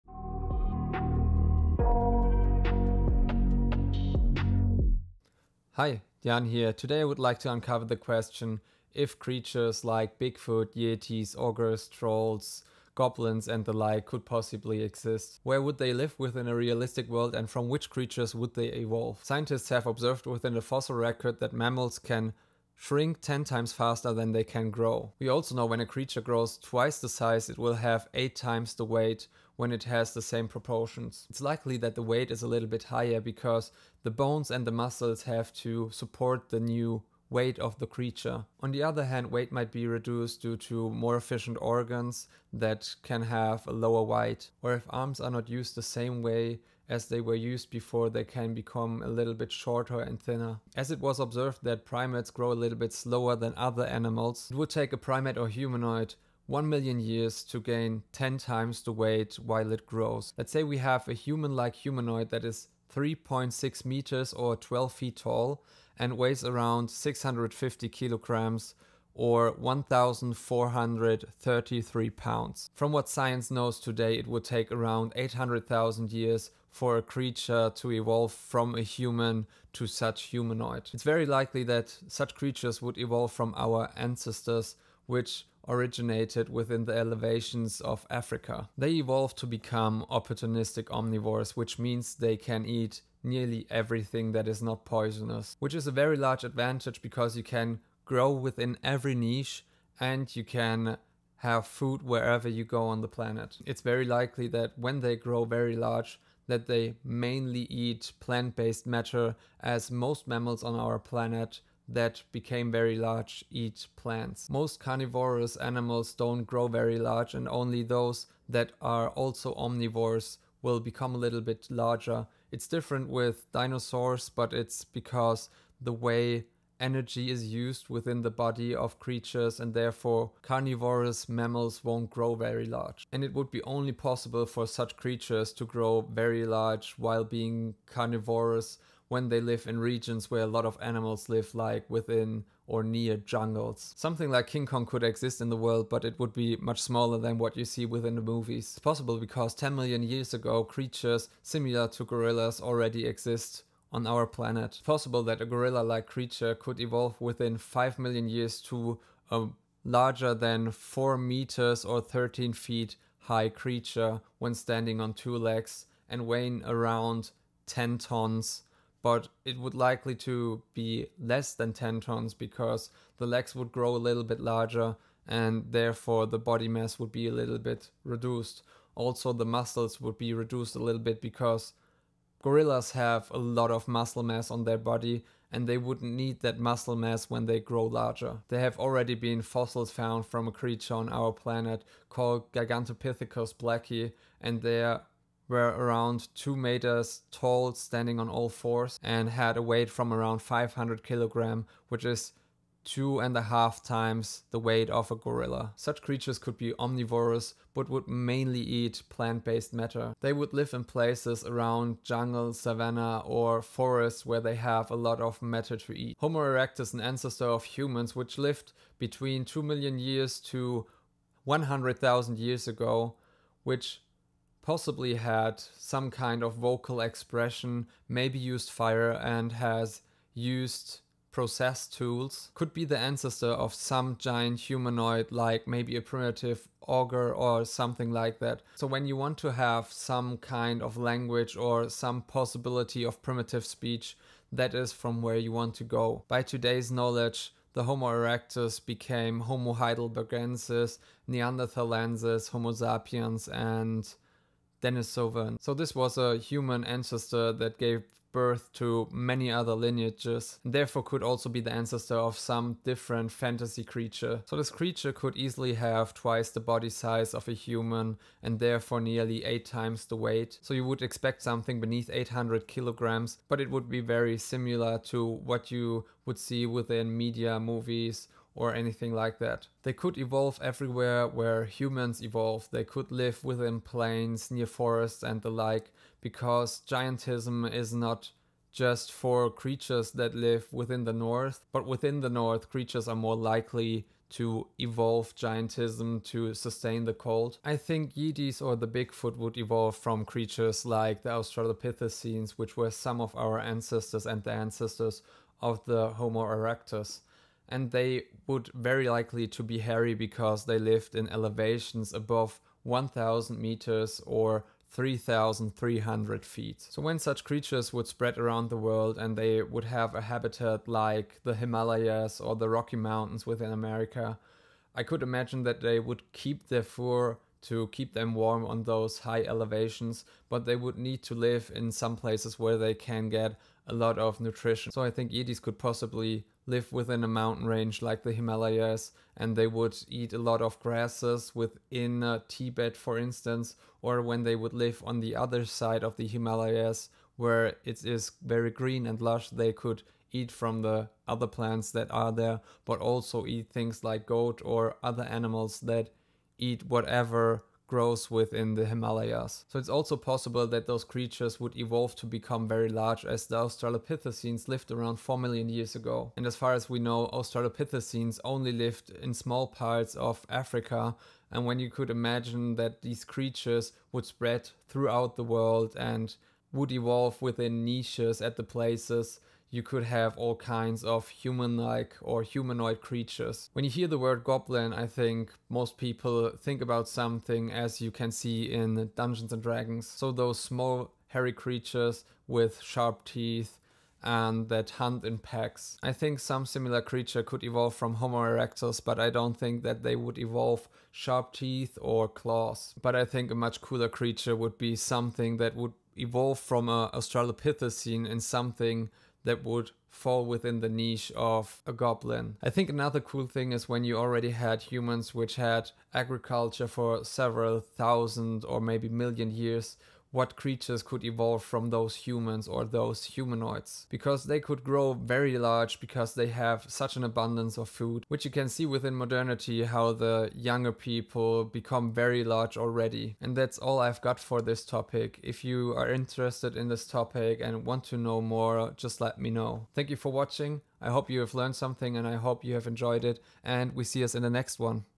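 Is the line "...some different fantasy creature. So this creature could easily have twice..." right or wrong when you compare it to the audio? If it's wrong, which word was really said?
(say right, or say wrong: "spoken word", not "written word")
right.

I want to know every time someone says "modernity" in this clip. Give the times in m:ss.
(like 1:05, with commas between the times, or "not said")
7:09.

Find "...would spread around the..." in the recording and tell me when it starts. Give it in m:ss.
5:17.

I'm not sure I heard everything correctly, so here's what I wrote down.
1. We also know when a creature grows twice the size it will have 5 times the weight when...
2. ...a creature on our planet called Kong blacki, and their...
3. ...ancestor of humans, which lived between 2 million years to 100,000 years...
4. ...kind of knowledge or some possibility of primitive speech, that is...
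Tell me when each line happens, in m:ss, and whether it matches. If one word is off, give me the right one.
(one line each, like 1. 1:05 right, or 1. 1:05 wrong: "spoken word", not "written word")
1. 0:25 wrong: "8", not "5"
2. 3:10 wrong: "Gigantopithecus", not "Kong"
3. 3:37 right
4. 4:00 wrong: "language", not "knowledge".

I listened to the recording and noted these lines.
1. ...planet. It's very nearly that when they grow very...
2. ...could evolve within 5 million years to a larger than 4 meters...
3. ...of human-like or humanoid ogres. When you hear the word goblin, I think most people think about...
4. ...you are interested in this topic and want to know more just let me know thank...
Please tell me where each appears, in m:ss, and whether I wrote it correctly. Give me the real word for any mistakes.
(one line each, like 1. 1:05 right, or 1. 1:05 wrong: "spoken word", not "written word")
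1. 1:43 wrong: "likely", not "nearly"
2. 2:36 right
3. 6:21 wrong: "creatures", not "ogres"
4. 7:15 right.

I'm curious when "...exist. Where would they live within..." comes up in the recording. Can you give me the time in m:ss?
0:14.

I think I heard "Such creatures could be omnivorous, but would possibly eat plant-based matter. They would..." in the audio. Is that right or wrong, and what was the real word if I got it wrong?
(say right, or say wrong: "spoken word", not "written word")
wrong: "mainly", not "possibly".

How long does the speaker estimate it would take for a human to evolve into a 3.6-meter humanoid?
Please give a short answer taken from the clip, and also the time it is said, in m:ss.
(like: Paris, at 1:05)
800,000 years, at 1:15.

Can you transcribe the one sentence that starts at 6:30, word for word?
So those small hairy creatures with sharp teeth and that hunt in packs.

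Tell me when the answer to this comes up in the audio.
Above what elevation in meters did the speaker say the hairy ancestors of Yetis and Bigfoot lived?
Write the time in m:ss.
5:12.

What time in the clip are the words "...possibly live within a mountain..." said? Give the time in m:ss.
5:35.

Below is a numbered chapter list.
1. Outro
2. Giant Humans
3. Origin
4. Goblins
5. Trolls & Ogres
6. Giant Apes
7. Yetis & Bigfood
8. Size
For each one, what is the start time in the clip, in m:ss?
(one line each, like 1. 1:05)
1. 7:13
2. 6:52
3. 1:20
4. 6:23
5. 3:35
6. 2:23
7. 4:57
8. 0:18.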